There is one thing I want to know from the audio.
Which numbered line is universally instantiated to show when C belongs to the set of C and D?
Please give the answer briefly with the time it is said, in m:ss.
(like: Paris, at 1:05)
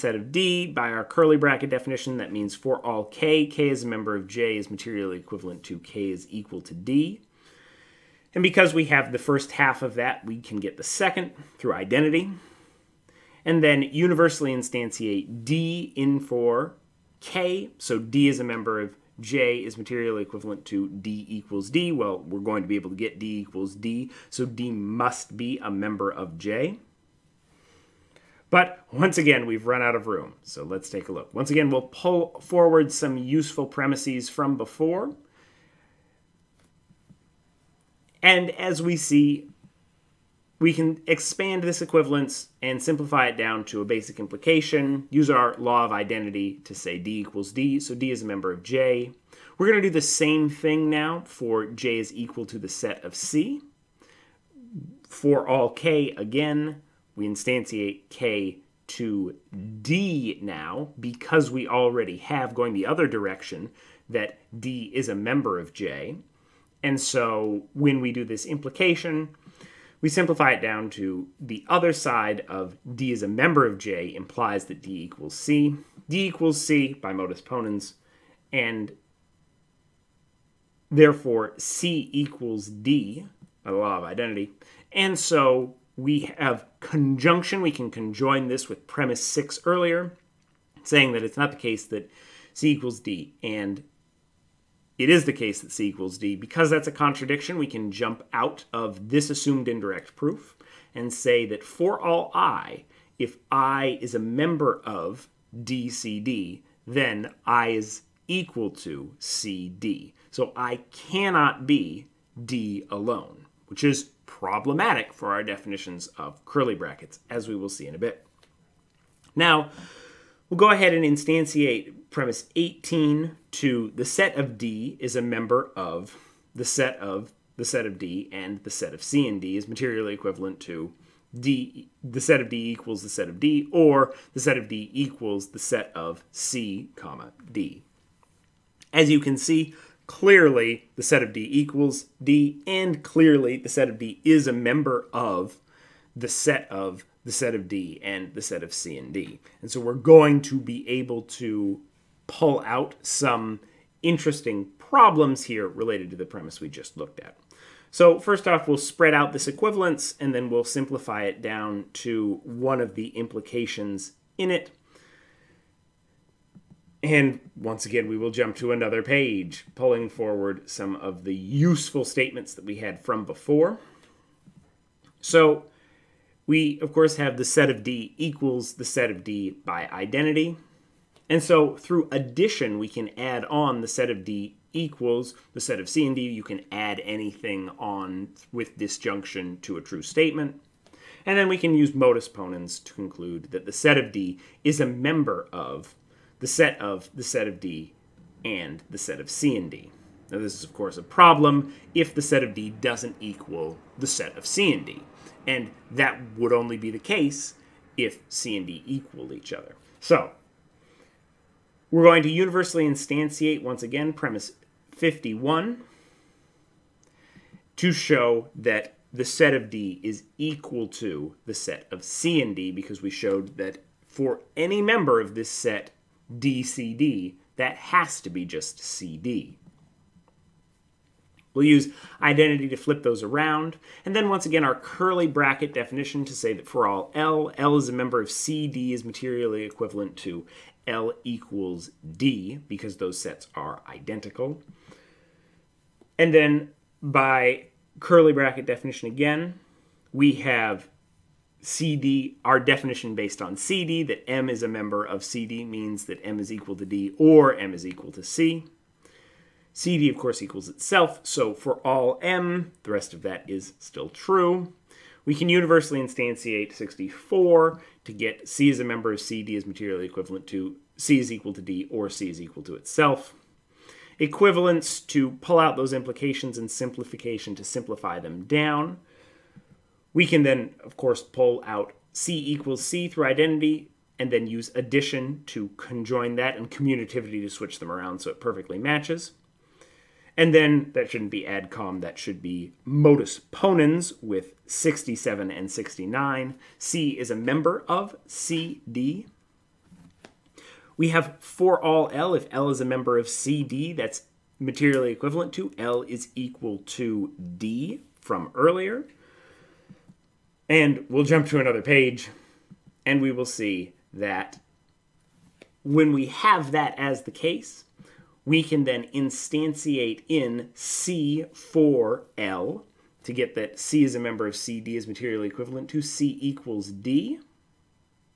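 64, at 4:26.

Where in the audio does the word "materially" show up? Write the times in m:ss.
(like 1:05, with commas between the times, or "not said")
0:04, 0:19, 2:09, 3:59, 4:29, 5:04, 5:25.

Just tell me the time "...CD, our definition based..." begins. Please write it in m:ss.
4:11.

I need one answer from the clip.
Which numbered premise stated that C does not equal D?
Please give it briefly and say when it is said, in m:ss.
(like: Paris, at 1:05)
6, at 1:28.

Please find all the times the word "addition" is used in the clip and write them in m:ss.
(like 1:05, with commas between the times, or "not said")
3:02, 4:44.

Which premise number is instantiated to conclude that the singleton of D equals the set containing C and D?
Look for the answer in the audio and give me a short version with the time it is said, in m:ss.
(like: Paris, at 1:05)
51, at 3:34.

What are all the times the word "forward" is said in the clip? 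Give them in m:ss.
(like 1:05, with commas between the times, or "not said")
0:32, 2:50.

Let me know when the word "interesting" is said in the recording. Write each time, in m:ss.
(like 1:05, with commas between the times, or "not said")
2:34.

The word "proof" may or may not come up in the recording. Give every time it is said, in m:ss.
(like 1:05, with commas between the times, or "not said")
1:40.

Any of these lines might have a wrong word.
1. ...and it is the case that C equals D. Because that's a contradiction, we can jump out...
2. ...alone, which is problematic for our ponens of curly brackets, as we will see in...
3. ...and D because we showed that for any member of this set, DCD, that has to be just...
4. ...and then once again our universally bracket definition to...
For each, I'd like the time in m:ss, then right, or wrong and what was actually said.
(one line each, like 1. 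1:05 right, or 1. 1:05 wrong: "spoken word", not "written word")
1. 1:33 right
2. 1:52 wrong: "definitions", not "ponens"
3. 3:42 right
4. 3:54 wrong: "curly", not "universally".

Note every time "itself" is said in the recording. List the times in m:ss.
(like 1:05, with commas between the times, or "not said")
4:20, 4:32.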